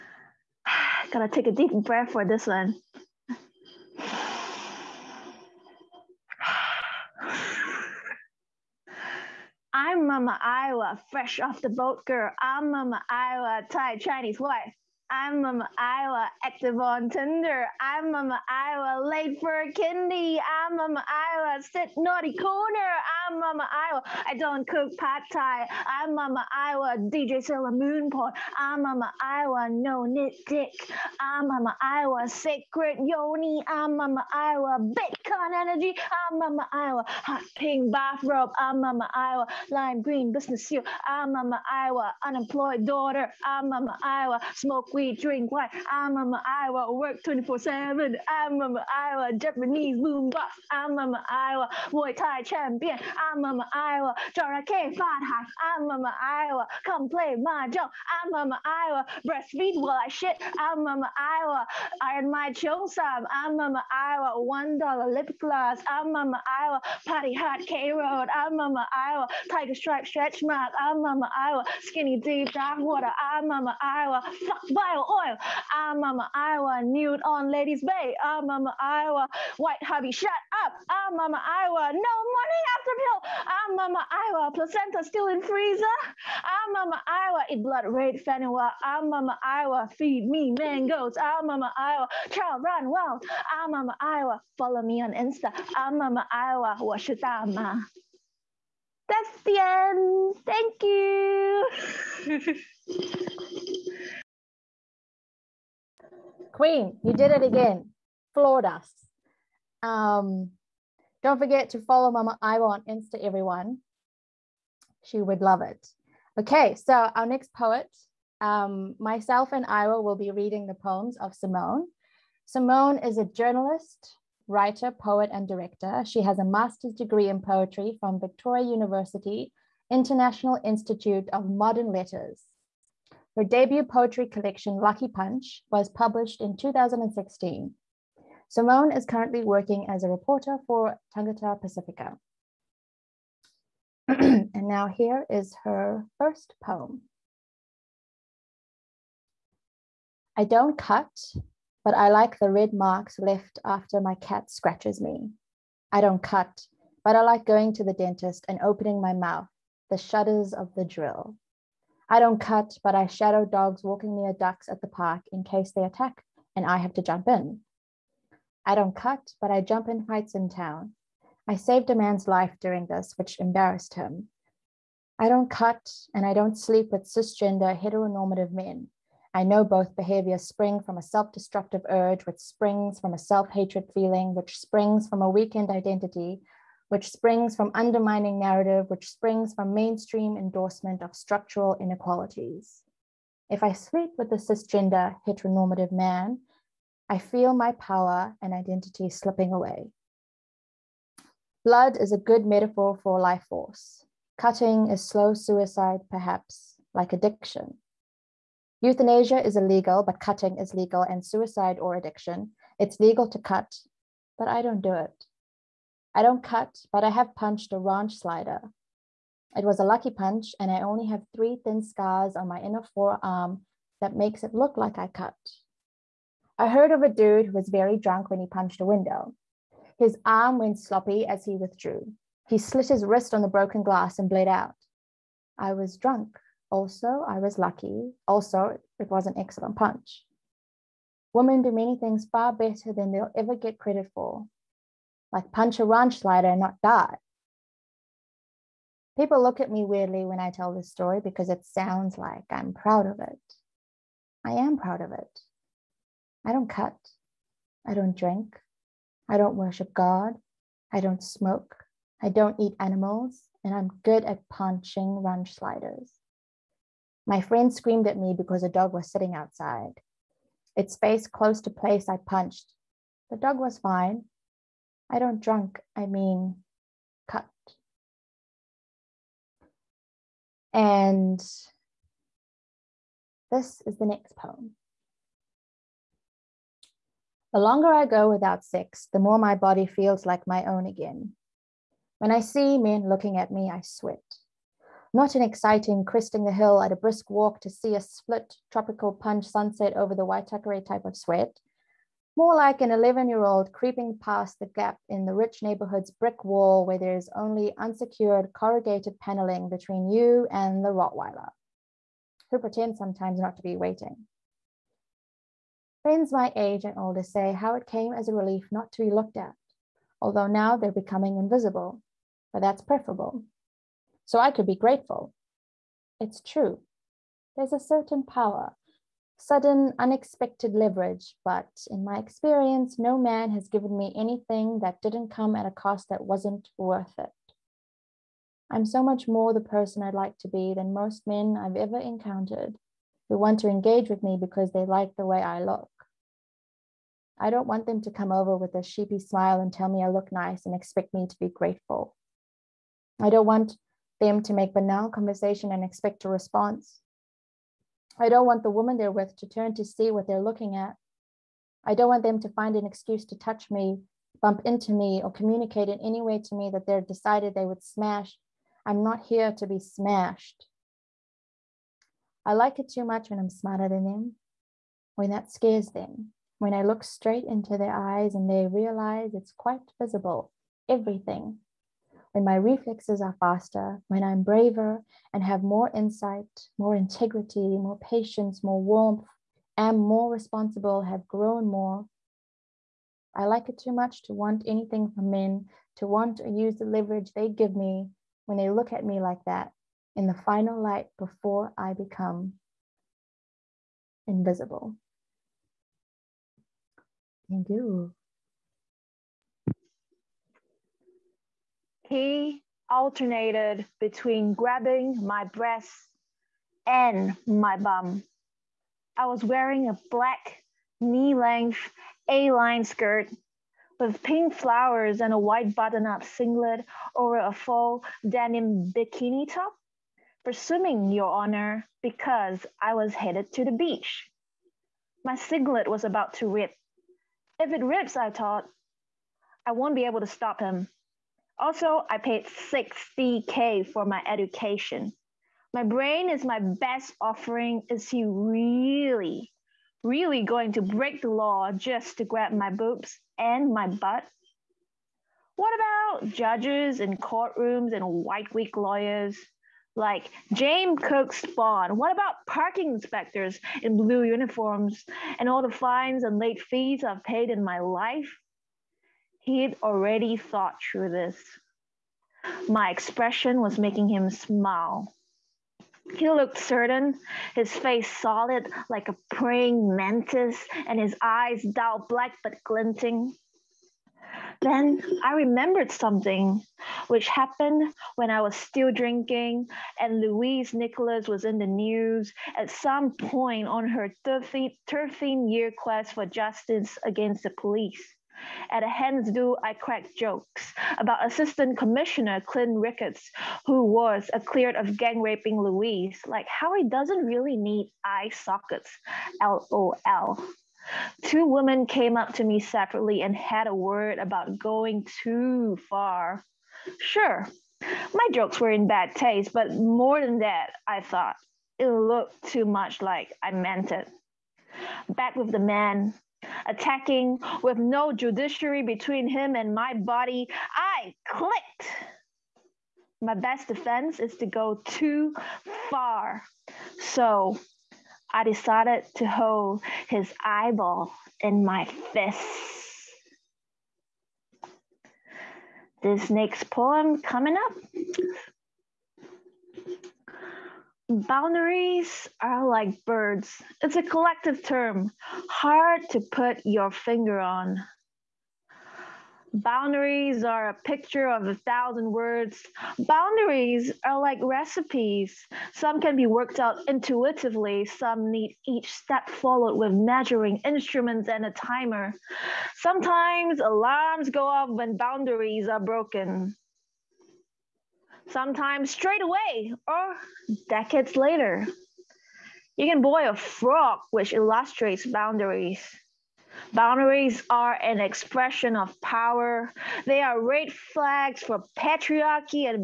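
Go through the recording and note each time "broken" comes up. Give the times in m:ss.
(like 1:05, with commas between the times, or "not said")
3:53, 9:35.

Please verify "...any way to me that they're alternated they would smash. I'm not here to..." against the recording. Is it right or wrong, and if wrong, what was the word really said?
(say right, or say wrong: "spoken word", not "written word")
wrong: "decided", not "alternated".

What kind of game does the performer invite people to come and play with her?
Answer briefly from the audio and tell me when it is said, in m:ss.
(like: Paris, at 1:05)
Mahjong, at 0:56.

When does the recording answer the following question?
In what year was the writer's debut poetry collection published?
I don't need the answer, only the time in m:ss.
2:16.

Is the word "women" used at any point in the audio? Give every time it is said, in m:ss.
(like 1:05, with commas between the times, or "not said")
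4:01, 8:31.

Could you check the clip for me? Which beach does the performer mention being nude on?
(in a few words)
Ladies Bay.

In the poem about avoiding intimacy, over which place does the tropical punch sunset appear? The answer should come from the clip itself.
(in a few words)
The Waitakere.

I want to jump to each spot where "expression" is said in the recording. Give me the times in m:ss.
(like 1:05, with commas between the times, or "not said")
7:52, 9:47.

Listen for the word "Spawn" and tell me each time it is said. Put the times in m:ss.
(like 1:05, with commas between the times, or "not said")
7:41.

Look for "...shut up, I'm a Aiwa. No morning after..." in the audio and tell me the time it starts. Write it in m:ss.
1:20.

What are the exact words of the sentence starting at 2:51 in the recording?
I saved a man's life during this, which embarrassed him.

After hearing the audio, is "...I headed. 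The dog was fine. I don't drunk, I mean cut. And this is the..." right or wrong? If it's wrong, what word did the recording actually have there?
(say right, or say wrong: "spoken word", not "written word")
wrong: "punched", not "headed".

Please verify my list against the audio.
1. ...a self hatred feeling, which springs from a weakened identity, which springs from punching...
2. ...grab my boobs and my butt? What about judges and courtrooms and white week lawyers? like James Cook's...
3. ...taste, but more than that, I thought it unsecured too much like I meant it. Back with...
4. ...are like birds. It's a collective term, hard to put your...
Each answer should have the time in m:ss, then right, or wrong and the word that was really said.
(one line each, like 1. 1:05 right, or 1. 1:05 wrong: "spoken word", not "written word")
1. 3:03 wrong: "undermining", not "punching"
2. 7:32 right
3. 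8:39 wrong: "looked", not "unsecured"
4. 9:12 right.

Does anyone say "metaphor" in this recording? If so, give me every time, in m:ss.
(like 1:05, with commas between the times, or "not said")
3:22.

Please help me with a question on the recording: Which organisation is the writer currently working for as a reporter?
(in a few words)
Tangata Pacifica.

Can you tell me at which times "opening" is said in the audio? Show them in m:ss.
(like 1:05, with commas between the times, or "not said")
2:38.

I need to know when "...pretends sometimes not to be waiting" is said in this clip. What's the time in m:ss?
5:12.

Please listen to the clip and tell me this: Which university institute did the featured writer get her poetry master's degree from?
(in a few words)
International Institute of Modern Letters.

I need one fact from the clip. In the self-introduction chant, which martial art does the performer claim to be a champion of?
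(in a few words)
Muay Thai.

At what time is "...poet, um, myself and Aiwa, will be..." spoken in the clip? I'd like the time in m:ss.
1:57.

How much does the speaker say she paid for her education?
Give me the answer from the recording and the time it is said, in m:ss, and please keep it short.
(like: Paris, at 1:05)
60K, at 7:22.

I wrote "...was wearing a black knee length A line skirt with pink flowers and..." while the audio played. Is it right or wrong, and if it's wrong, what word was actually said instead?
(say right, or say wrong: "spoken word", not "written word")
right.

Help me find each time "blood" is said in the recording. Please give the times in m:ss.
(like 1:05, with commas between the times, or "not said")
1:27, 3:21.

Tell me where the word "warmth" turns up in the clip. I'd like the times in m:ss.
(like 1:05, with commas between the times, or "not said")
6:28.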